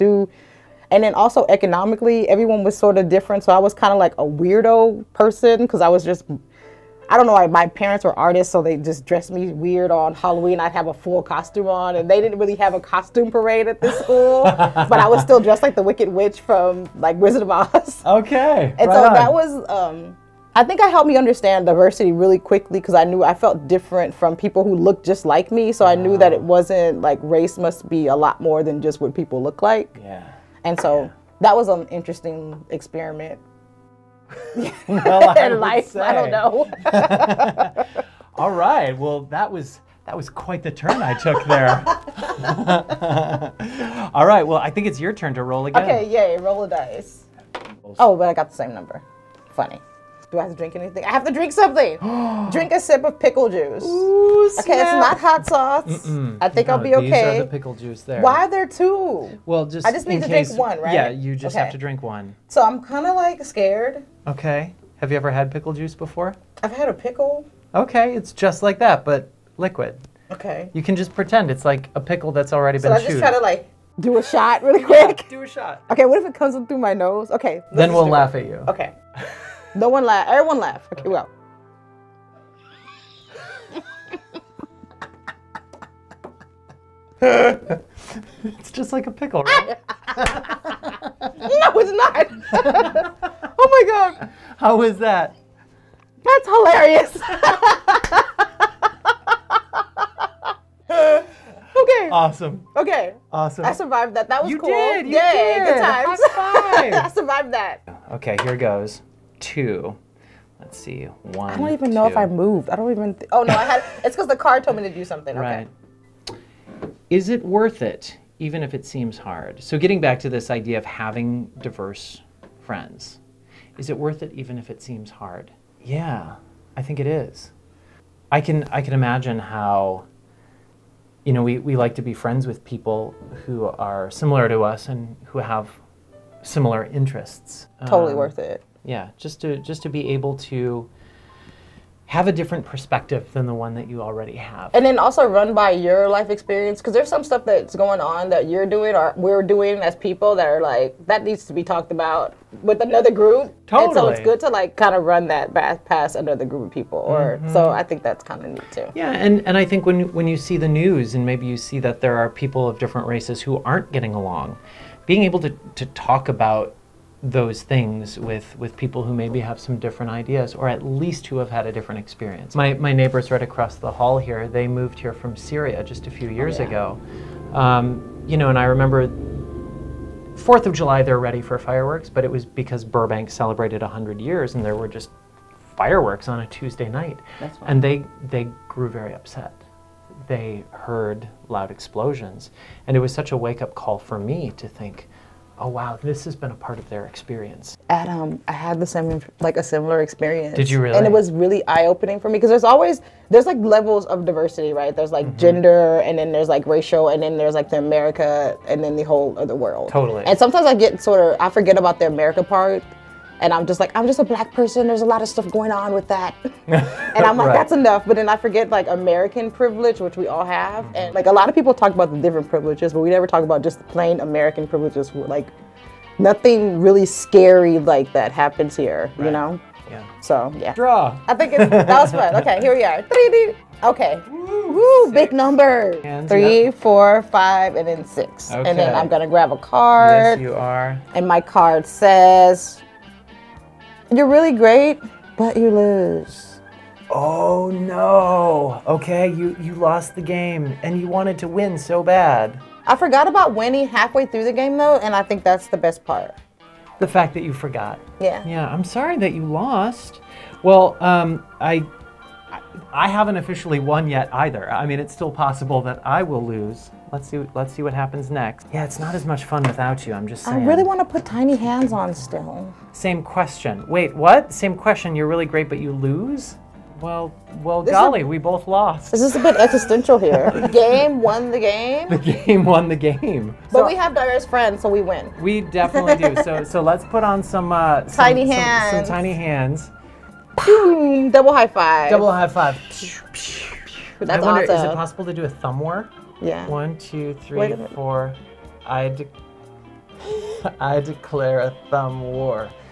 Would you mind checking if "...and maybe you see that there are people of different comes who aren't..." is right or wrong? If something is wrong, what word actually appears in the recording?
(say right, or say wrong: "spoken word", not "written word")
wrong: "races", not "comes".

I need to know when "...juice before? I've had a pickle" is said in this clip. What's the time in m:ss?
1:05.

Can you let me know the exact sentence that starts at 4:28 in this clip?
Yeah, it's not as much fun without you, I'm just saying.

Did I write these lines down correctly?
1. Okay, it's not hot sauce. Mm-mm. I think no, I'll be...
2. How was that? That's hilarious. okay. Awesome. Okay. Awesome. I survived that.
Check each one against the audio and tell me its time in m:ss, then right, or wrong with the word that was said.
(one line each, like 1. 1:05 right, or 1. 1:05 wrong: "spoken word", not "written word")
1. 0:54 right
2. 1:34 right.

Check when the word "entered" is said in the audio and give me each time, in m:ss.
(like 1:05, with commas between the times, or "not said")
not said.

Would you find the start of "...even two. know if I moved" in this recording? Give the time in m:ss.
1:51.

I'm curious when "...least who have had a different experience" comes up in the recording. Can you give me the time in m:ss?
2:50.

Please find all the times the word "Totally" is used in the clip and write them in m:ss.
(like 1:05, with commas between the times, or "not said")
2:17, 2:33, 3:29.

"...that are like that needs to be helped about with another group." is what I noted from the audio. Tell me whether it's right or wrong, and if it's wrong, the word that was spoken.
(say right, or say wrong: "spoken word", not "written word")
wrong: "talked", not "helped".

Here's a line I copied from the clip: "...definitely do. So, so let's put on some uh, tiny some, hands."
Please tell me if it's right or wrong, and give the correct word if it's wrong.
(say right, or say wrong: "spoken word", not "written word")
right.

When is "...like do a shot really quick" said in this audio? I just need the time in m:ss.
1:13.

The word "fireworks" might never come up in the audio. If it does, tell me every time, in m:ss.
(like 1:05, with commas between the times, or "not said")
3:01, 3:05.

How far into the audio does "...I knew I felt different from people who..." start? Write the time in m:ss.
0:22.